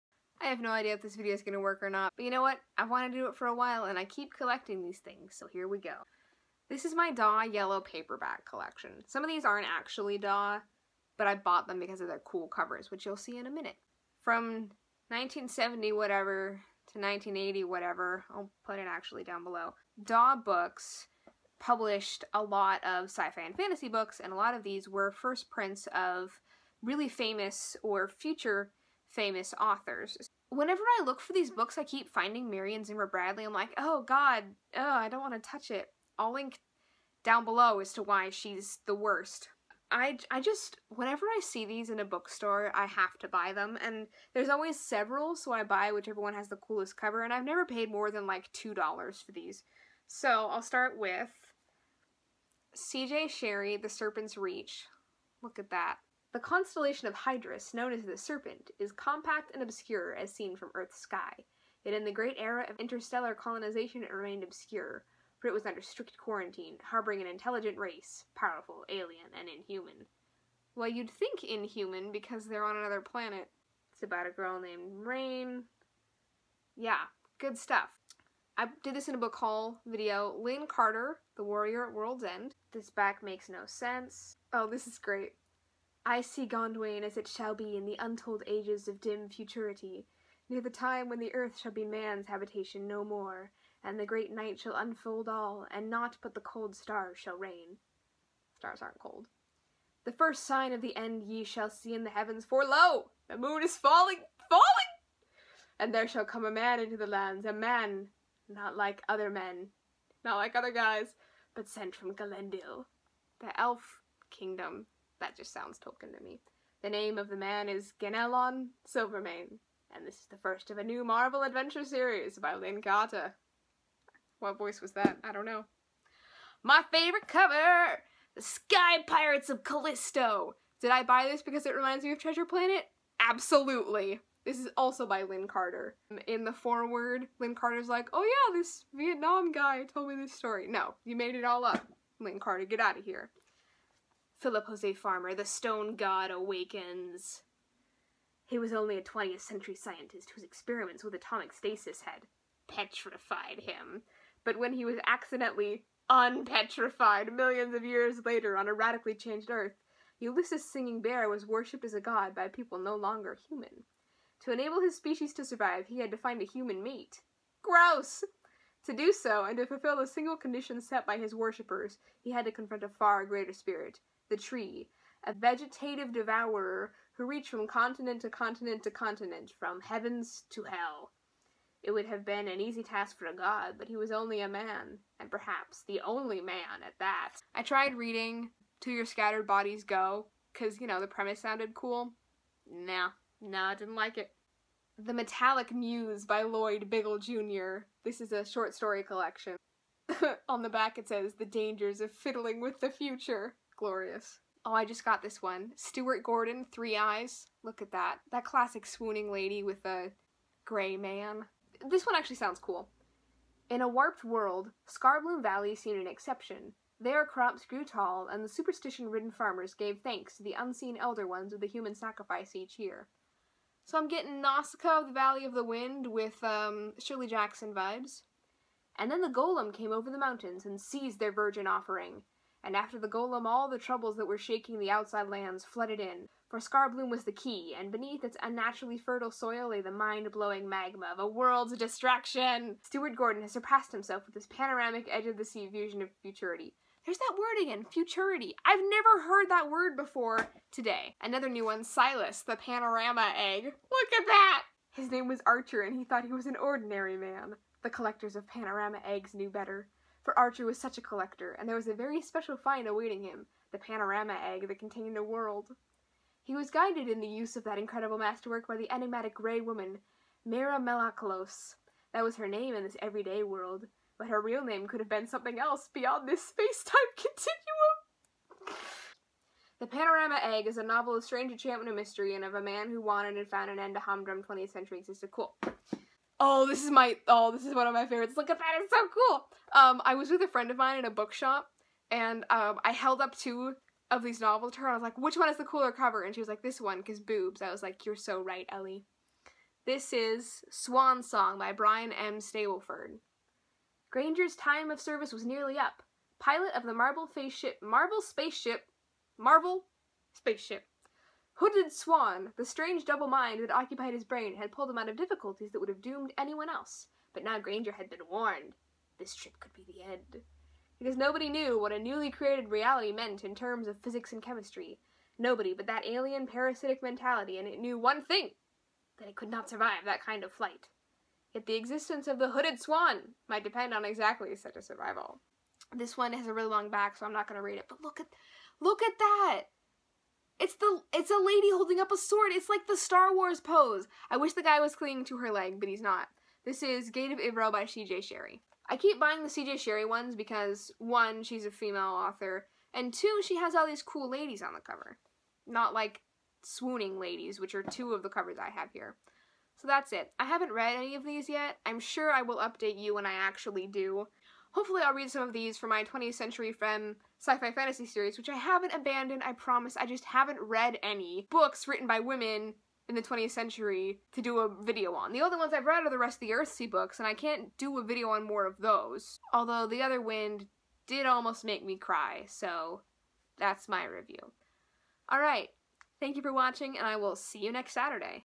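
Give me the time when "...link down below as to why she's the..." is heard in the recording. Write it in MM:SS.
00:36.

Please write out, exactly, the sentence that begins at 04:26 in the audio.
He was guided in the use of that incredible masterwork by the enigmatic gray woman, Mira Melakalos.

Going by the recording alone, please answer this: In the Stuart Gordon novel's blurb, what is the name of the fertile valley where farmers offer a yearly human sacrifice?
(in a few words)
Scarbloom Valley.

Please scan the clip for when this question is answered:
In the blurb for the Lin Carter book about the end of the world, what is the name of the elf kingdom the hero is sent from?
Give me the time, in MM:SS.
01:52.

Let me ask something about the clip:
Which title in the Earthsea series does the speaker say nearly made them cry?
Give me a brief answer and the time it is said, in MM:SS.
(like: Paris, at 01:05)
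The Other Wind, at 06:19.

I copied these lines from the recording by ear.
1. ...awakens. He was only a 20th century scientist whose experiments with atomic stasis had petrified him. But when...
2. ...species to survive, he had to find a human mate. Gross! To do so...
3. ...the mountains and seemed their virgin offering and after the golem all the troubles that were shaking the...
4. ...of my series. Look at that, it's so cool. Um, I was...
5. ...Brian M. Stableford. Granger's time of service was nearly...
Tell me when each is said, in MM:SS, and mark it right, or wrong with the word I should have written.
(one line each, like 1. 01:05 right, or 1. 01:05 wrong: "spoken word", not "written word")
1. 02:26 right
2. 02:44 right
3. 03:50 wrong: "seized", not "seemed"
4. 04:47 wrong: "favorites", not "series"
5. 05:01 right.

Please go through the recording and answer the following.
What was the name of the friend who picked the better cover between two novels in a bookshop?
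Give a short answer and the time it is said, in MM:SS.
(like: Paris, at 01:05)
Ellie, at 04:58.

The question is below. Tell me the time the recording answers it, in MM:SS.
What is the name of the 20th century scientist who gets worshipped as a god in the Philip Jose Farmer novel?
02:40.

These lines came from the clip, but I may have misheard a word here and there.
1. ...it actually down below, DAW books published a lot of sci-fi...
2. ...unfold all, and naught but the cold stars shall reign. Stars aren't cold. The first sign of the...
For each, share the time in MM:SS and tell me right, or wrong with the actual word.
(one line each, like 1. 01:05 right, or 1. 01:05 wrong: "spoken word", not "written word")
1. 00:18 right
2. 01:34 right.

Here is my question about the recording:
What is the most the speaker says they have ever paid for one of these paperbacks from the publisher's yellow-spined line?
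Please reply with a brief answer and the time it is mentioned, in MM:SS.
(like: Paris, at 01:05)
$2, at 00:48.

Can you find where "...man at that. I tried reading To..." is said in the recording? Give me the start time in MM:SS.
03:06.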